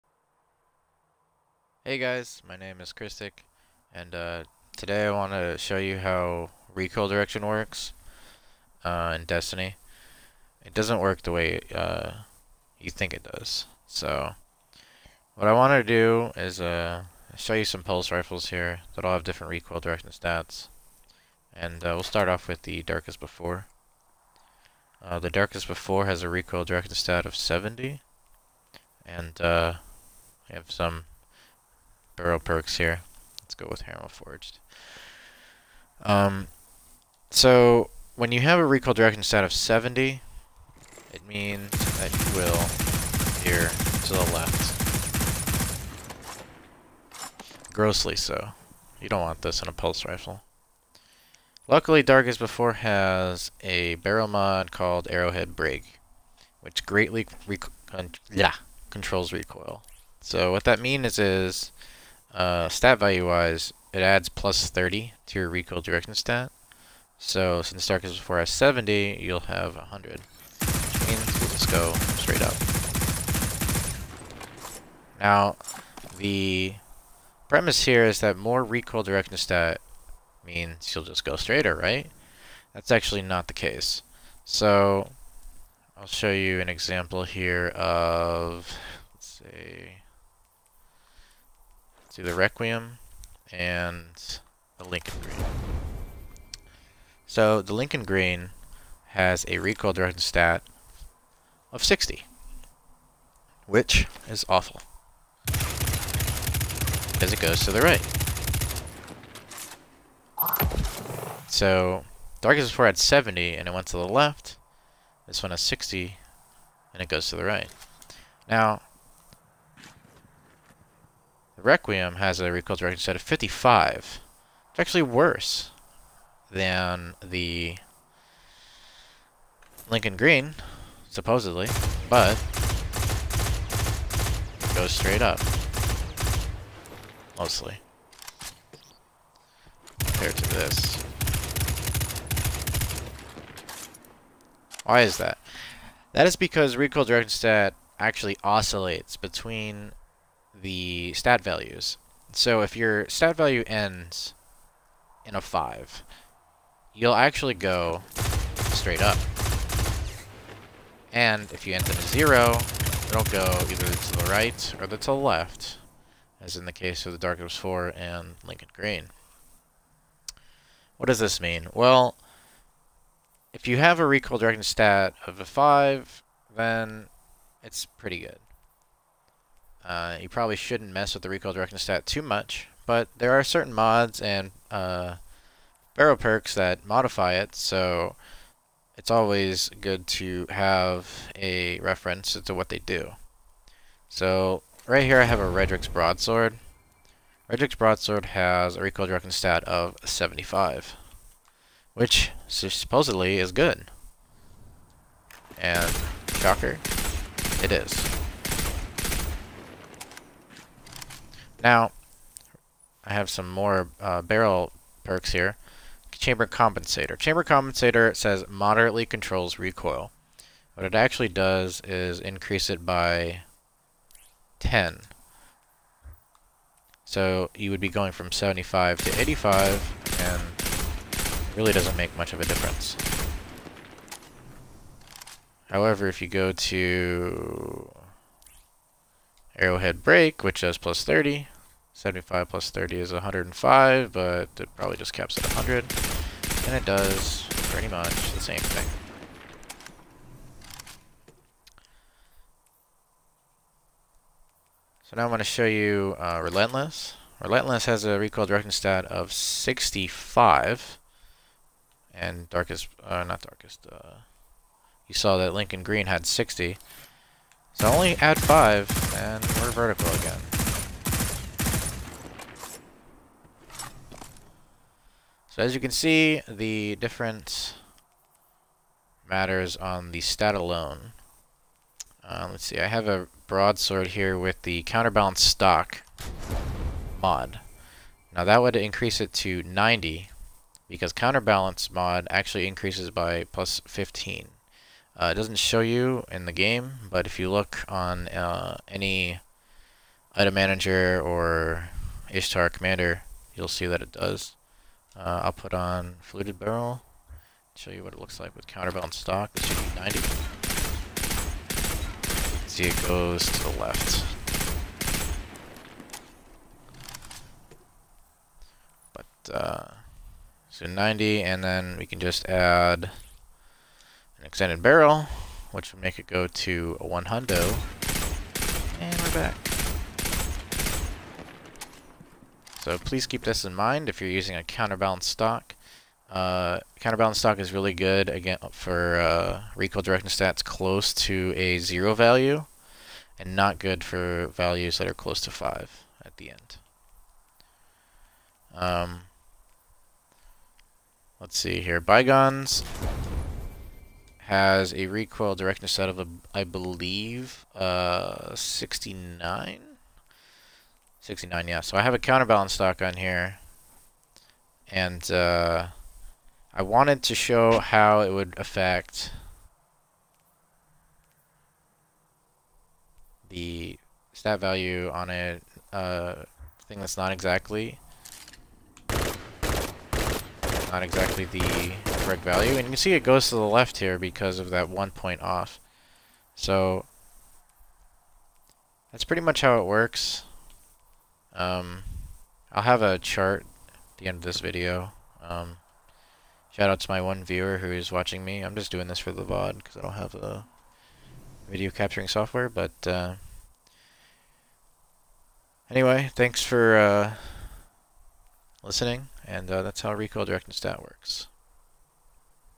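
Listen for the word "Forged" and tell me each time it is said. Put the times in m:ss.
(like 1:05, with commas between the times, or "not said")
0:34.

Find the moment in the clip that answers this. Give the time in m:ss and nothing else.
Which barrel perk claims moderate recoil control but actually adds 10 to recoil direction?
3:37.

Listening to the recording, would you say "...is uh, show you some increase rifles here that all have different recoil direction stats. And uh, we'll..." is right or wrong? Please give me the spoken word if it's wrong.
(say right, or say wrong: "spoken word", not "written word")
wrong: "pulse", not "increase".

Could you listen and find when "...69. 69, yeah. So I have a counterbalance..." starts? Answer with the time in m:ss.
5:58.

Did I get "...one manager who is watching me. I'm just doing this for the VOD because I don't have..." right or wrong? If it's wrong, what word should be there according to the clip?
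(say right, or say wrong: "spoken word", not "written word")
wrong: "viewer", not "manager".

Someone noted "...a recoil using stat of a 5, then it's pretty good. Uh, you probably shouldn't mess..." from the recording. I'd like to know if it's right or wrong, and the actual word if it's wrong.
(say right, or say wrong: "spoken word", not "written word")
wrong: "directing", not "using".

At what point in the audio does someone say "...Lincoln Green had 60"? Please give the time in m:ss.
4:25.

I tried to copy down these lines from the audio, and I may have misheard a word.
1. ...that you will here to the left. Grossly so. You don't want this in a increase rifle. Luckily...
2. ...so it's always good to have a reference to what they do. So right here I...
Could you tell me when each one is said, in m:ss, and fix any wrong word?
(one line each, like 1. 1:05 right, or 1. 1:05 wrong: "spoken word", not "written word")
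1. 0:41 wrong: "pulse", not "increase"
2. 3:07 right.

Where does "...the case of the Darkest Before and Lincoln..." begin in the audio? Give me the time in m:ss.
2:46.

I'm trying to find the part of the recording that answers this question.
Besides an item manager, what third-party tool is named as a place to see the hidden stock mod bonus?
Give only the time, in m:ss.
5:02.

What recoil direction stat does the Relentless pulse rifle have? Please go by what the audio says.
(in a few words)
65.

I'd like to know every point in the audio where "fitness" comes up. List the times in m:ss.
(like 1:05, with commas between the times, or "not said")
not said.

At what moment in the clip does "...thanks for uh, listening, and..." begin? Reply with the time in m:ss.
6:46.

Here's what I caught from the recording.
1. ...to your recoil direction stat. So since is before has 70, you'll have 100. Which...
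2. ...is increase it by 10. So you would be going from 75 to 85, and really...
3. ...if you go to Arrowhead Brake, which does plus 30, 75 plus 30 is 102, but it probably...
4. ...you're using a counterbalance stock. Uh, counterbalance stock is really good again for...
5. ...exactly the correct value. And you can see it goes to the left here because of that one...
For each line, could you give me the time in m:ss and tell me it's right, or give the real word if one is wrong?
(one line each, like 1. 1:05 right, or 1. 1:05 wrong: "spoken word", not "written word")
1. 1:05 right
2. 3:41 right
3. 3:56 wrong: "105", not "102"
4. 5:34 right
5. 6:21 right.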